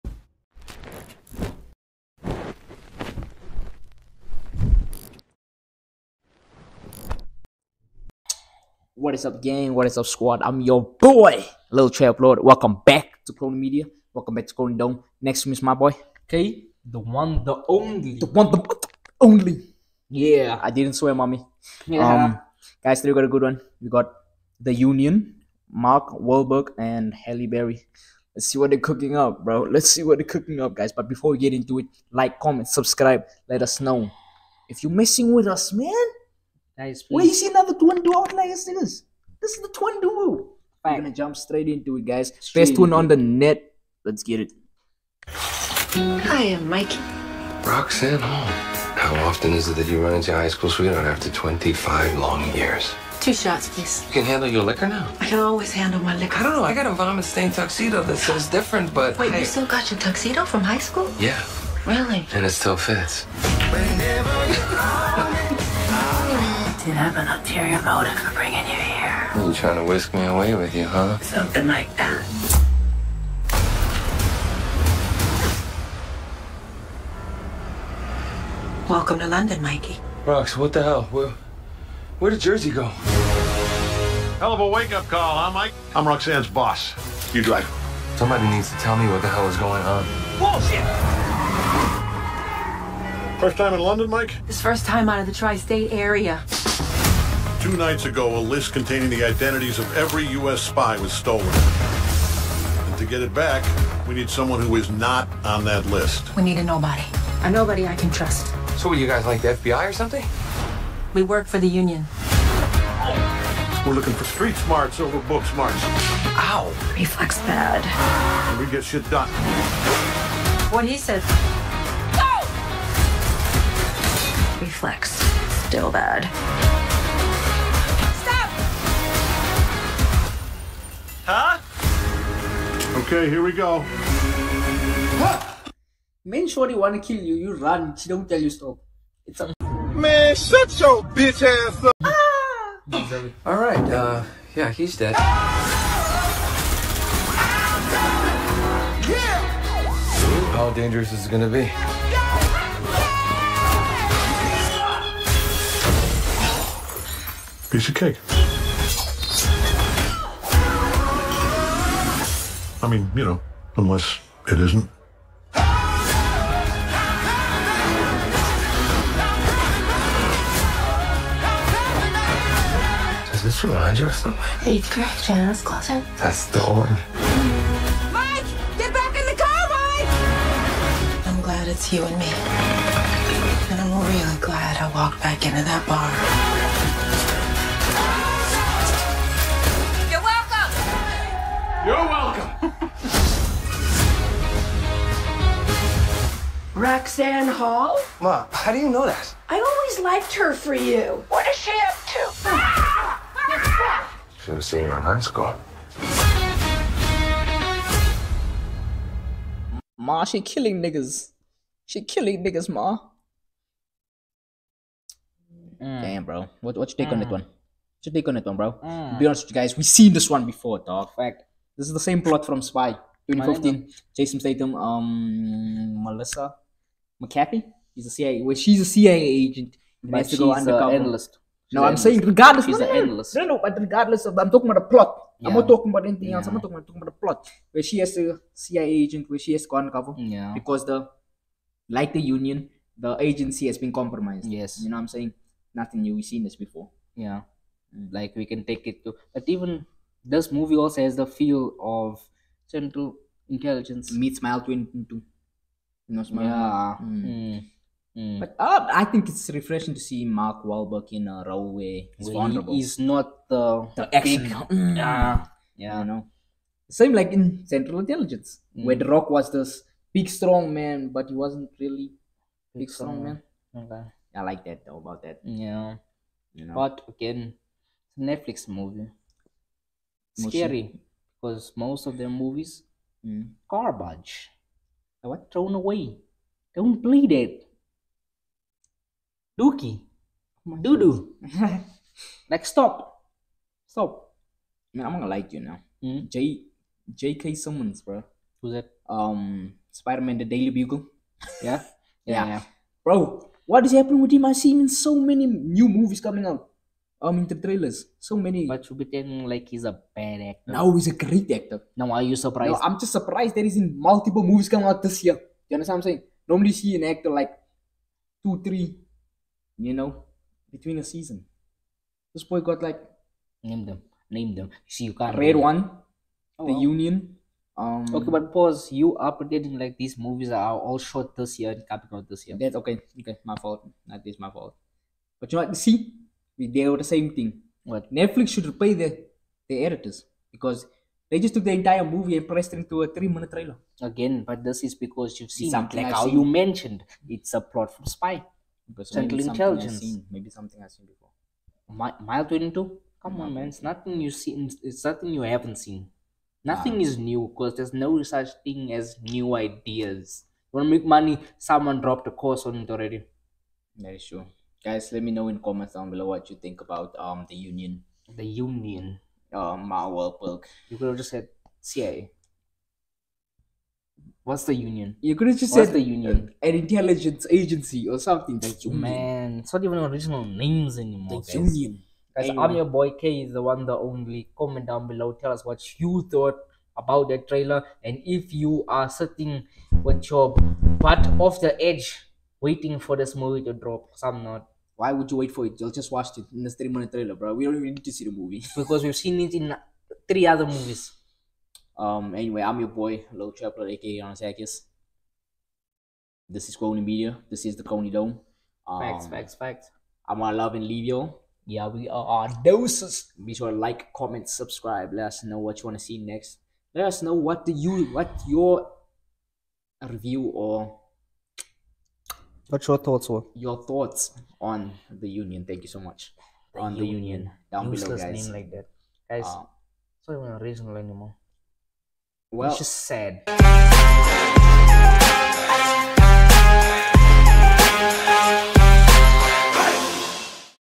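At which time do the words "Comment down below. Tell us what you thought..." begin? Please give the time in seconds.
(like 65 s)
384 s.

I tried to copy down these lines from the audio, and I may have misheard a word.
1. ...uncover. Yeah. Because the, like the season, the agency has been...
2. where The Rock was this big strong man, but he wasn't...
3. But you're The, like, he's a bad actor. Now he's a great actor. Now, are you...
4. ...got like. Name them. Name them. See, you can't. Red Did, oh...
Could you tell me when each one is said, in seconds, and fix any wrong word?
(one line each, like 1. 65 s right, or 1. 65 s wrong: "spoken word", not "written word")
1. 239 s wrong: "union", not "season"
2. 268 s right
3. 308 s wrong: "Chubitan", not "The"
4. 322 s wrong: "One", not "Did".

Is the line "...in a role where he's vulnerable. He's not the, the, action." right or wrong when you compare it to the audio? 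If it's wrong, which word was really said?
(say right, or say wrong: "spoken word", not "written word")
right.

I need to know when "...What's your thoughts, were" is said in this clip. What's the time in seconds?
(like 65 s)
422 s.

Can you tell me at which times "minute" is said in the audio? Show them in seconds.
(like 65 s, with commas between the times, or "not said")
343 s, 396 s.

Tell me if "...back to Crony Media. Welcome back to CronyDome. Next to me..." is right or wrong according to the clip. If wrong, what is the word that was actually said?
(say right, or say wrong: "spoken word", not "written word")
right.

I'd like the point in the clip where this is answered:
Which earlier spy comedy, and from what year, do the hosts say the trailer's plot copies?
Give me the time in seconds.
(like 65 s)
222 s.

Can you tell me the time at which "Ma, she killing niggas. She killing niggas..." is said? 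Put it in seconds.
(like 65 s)
209 s.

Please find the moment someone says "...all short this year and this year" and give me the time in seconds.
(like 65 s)
330 s.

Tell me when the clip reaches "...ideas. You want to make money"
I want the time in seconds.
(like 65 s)
359 s.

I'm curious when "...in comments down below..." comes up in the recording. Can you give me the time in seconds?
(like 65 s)
365 s.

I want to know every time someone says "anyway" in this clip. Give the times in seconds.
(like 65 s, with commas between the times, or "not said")
382 s, 402 s.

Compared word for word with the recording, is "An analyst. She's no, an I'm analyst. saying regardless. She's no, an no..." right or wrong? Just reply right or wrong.
right.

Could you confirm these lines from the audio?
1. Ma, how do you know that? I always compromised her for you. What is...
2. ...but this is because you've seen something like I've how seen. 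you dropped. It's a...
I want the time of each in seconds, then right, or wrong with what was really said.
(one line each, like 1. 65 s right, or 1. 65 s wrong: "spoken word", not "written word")
1. 198 s wrong: "liked", not "compromised"
2. 344 s wrong: "mentioned", not "dropped".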